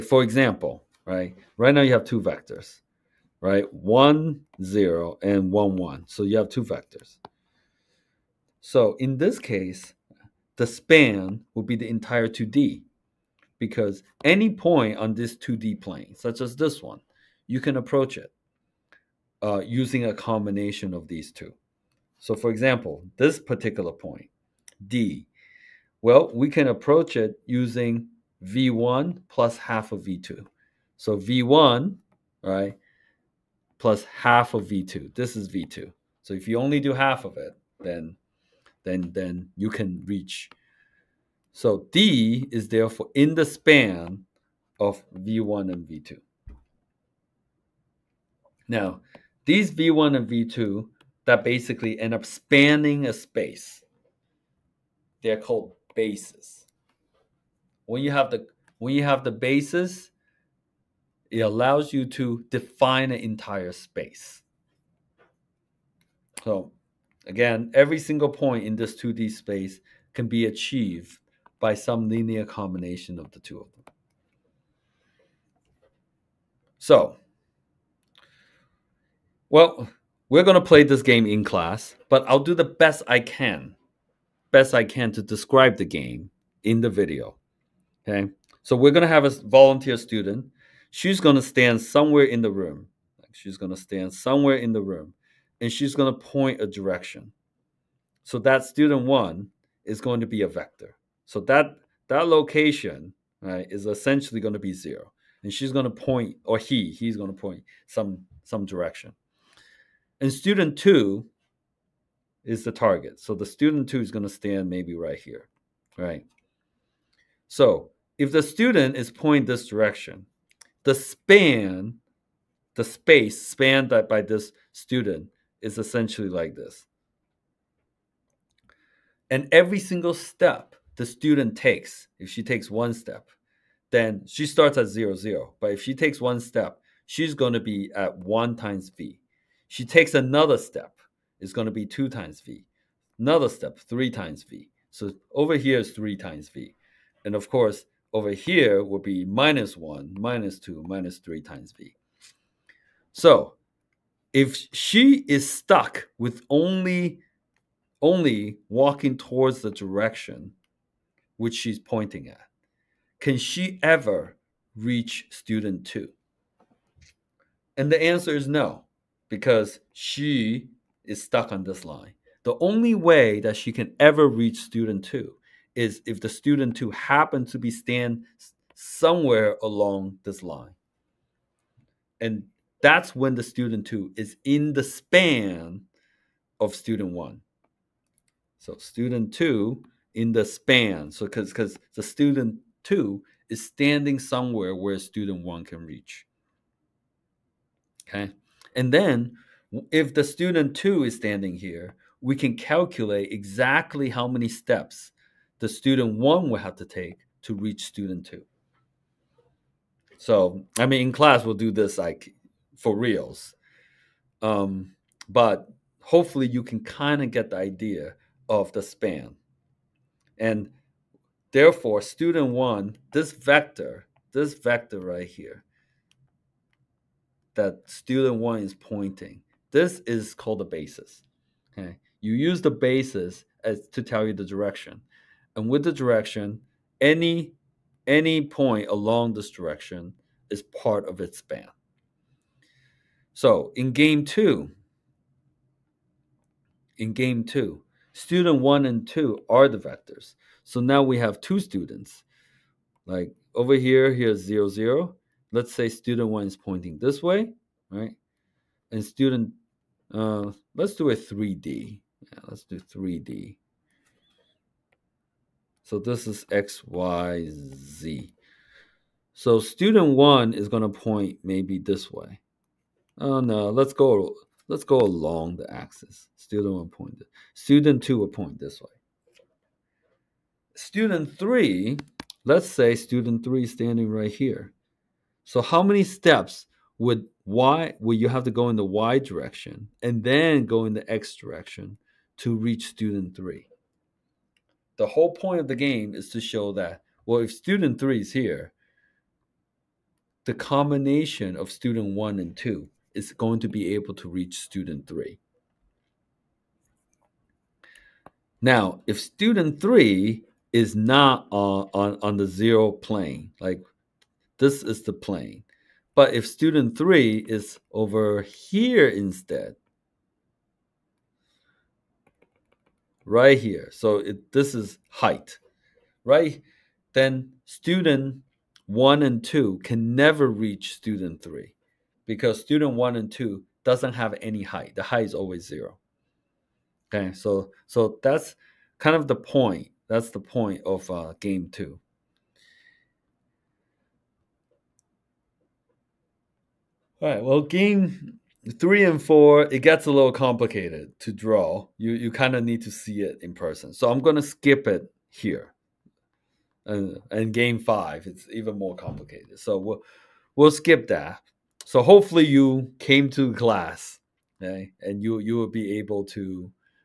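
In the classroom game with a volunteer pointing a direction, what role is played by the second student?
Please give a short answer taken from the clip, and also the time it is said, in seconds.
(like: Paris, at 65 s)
the target, at 112 s.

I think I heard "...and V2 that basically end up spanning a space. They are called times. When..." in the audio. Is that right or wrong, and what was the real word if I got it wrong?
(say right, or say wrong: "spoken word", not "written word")
wrong: "bases", not "times".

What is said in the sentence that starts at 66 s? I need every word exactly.
So again, every single point in this 2D space can be achieved by some linear combination of the two of them.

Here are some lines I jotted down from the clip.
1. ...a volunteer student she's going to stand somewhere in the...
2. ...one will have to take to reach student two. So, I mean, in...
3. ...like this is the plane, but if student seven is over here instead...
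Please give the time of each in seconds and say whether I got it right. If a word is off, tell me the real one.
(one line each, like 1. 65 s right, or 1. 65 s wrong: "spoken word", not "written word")
1. 89 s right
2. 206 s right
3. 313 s wrong: "three", not "seven".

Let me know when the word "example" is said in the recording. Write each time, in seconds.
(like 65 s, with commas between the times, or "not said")
0 s, 22 s.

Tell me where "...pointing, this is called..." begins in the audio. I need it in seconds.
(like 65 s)
228 s.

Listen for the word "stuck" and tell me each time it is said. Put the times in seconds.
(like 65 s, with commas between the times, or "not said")
155 s, 171 s.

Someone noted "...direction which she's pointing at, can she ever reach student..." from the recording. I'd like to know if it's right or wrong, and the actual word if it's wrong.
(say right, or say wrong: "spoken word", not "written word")
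right.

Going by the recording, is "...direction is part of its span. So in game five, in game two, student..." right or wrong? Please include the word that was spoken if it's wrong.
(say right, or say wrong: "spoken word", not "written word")
wrong: "two", not "five".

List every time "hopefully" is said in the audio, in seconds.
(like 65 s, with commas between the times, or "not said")
216 s, 362 s.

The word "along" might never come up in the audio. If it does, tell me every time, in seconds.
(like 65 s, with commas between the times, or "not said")
179 s, 238 s, 274 s.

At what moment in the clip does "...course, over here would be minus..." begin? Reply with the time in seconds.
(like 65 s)
147 s.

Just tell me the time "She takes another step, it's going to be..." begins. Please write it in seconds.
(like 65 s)
139 s.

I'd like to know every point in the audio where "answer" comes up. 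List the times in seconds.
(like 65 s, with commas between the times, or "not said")
168 s.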